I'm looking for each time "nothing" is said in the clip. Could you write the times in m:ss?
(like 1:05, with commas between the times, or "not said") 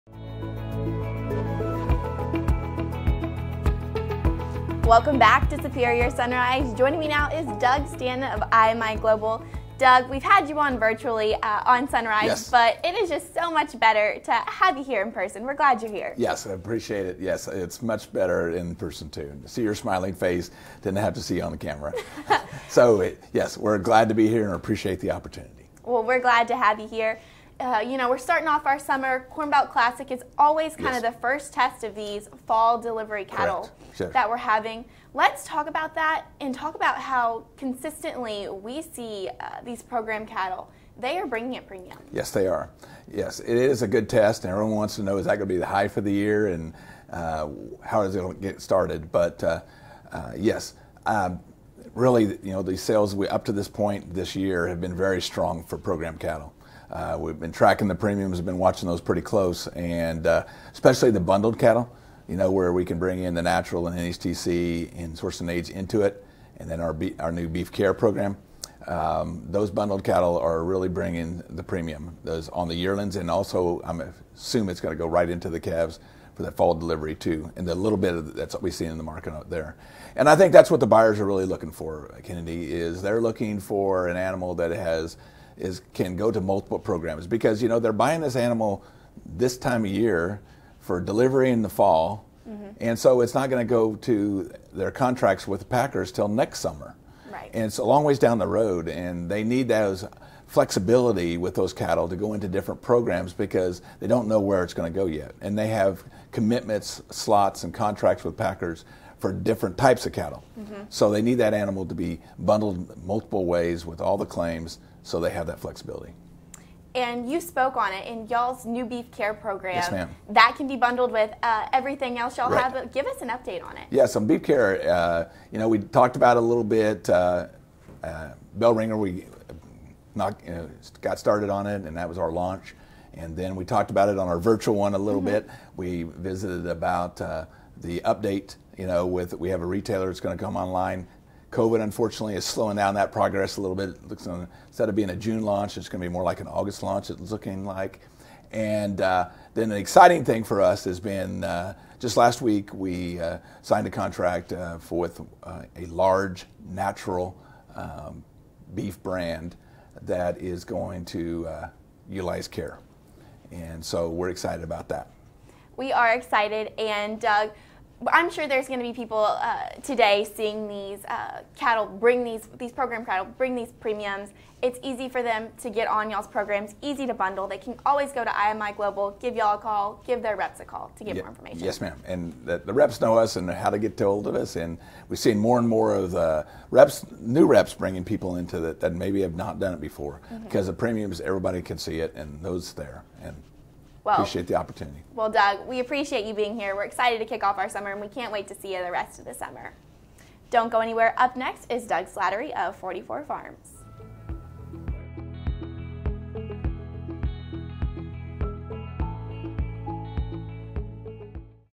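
not said.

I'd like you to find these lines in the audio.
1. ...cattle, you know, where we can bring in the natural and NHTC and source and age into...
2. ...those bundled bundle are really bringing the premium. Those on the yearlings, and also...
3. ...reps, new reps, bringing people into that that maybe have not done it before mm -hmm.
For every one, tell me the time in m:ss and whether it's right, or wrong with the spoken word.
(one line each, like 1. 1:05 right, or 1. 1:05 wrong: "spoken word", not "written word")
1. 1:01 right
2. 1:09 wrong: "cattle", not "bundle"
3. 3:06 right.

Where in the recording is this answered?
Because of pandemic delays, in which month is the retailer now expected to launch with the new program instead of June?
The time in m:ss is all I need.
2:26.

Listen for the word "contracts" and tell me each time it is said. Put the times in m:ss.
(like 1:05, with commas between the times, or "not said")
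1:34, 1:47, 2:33.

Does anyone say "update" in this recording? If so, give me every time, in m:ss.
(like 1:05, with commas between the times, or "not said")
2:03, 2:18.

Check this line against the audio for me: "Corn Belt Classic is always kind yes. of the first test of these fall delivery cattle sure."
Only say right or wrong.
right.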